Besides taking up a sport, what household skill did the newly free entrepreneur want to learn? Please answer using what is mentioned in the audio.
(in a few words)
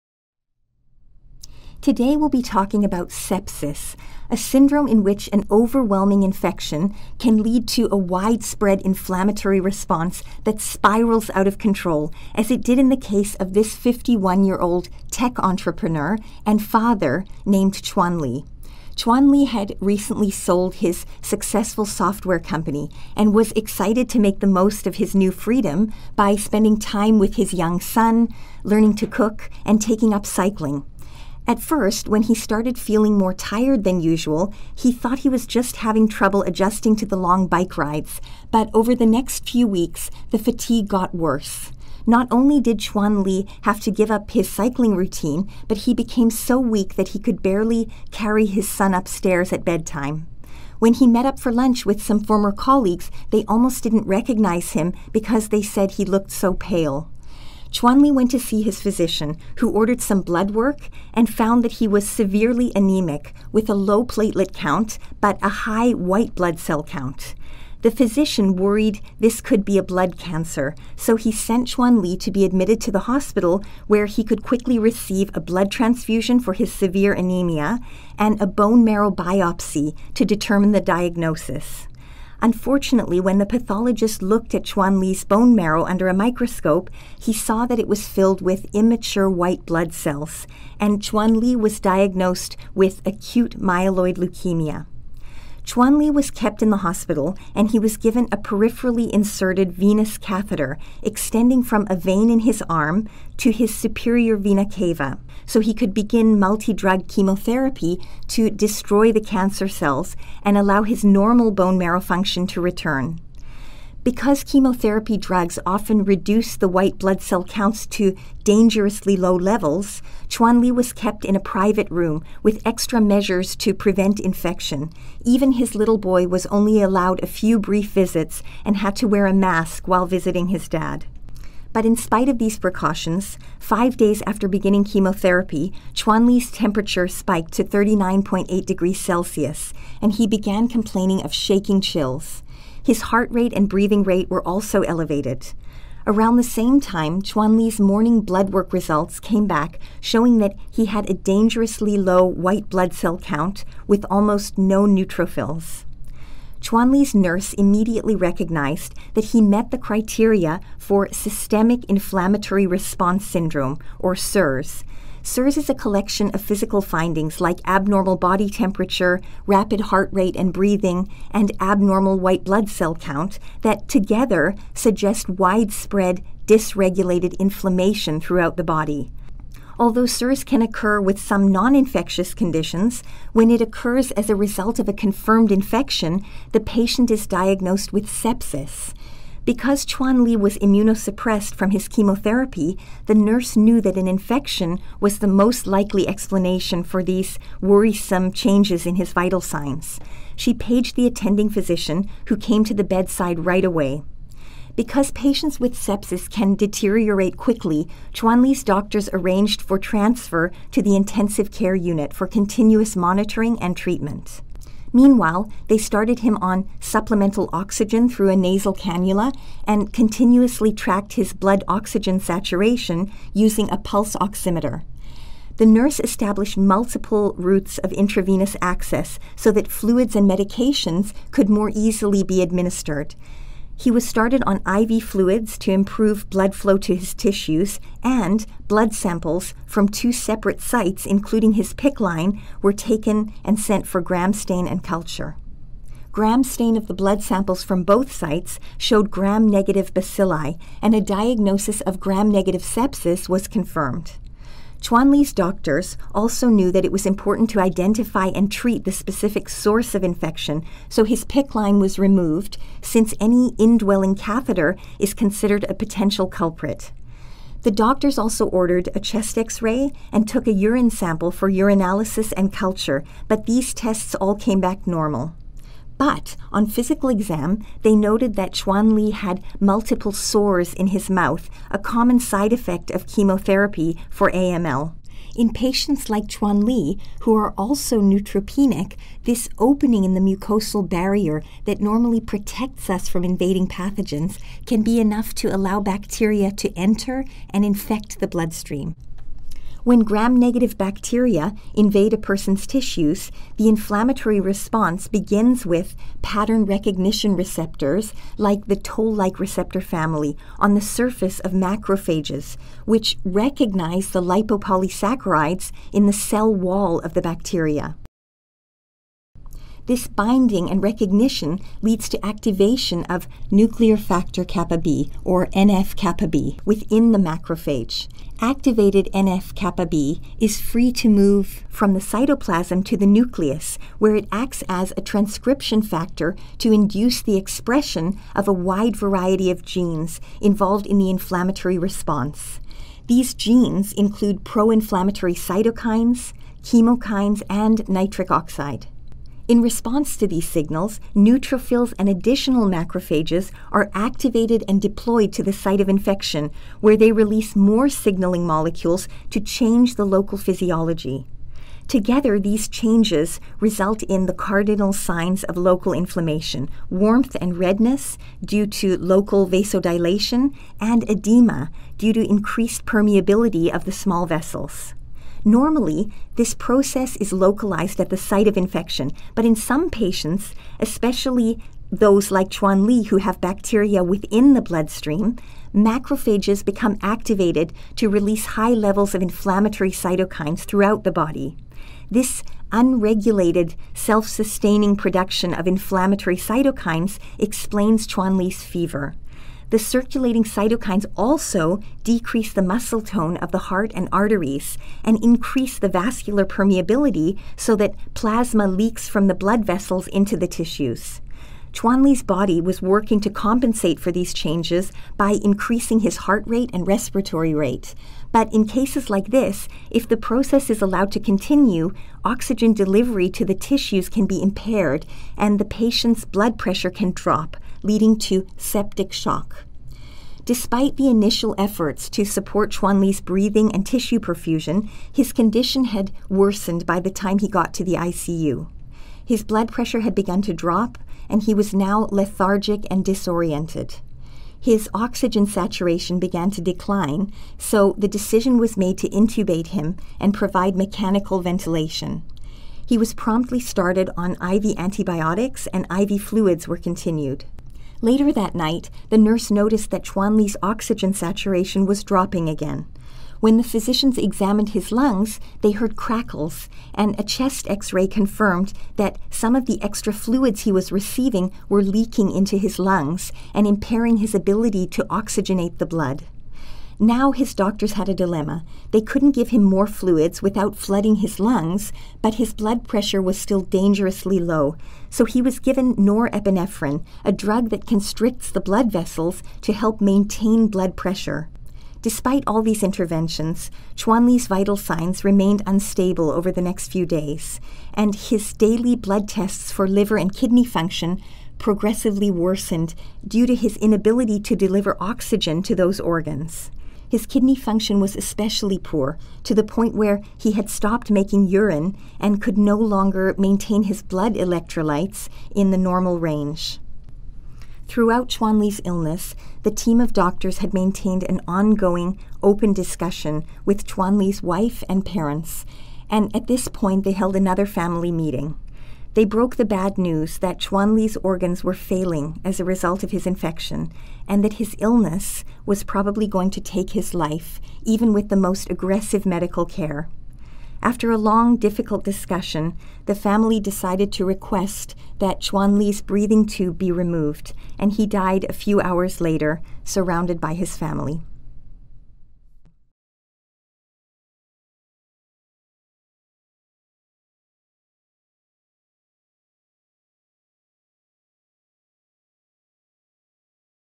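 to cook.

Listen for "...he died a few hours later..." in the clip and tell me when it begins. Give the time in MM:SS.
09:07.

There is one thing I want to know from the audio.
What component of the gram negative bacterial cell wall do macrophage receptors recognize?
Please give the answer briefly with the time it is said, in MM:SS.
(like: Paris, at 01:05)
lipopolysaccharides, at 05:14.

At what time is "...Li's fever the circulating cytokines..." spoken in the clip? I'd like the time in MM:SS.
06:38.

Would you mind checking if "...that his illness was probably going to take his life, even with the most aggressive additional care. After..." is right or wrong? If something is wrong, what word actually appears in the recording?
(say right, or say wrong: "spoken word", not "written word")
wrong: "medical", not "additional".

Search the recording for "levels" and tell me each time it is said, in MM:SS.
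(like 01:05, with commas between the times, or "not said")
01:59, 06:28.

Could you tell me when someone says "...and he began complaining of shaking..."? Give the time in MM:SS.
02:20.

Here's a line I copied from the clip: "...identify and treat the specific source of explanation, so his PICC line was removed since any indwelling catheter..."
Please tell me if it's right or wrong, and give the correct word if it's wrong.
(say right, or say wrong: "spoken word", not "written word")
wrong: "infection", not "explanation".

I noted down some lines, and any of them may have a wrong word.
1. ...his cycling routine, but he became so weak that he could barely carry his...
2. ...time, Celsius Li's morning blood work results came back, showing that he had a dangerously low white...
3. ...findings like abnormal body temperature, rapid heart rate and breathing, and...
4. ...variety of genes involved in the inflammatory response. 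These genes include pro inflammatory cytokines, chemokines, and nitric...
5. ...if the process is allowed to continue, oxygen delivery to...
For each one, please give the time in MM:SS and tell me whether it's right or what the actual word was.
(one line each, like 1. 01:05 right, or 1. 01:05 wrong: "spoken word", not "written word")
1. 00:44 right
2. 02:26 wrong: "Chuan", not "Celsius"
3. 02:46 right
4. 05:38 right
5. 06:59 right.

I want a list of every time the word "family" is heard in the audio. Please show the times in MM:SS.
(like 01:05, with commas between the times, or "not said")
05:09, 08:47, 09:03, 09:10.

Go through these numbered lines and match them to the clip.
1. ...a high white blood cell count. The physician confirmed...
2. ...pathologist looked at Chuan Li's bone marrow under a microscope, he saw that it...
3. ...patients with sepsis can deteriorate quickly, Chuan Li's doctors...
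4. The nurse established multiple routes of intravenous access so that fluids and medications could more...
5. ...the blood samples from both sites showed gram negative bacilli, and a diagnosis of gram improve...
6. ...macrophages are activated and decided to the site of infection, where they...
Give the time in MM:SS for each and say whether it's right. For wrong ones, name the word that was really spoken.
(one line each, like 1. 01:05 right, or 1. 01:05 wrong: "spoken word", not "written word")
1. 01:05 wrong: "worried", not "confirmed"
2. 01:23 right
3. 03:25 right
4. 03:45 right
5. 04:06 wrong: "negative", not "improve"
6. 05:52 wrong: "deployed", not "decided".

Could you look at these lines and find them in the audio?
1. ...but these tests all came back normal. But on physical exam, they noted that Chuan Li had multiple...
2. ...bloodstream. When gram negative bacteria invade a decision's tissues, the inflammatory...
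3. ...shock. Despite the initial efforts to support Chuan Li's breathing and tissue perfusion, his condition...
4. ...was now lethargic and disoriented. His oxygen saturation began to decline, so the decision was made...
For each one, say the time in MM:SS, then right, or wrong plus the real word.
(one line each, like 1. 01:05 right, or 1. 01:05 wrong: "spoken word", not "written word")
1. 04:33 right
2. 04:58 wrong: "person", not "decision"
3. 07:09 right
4. 07:21 right.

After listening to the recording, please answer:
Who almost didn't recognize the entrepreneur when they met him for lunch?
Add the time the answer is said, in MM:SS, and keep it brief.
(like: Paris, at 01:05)
former colleagues, at 00:52.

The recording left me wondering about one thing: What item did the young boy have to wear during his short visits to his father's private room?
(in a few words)
a mask.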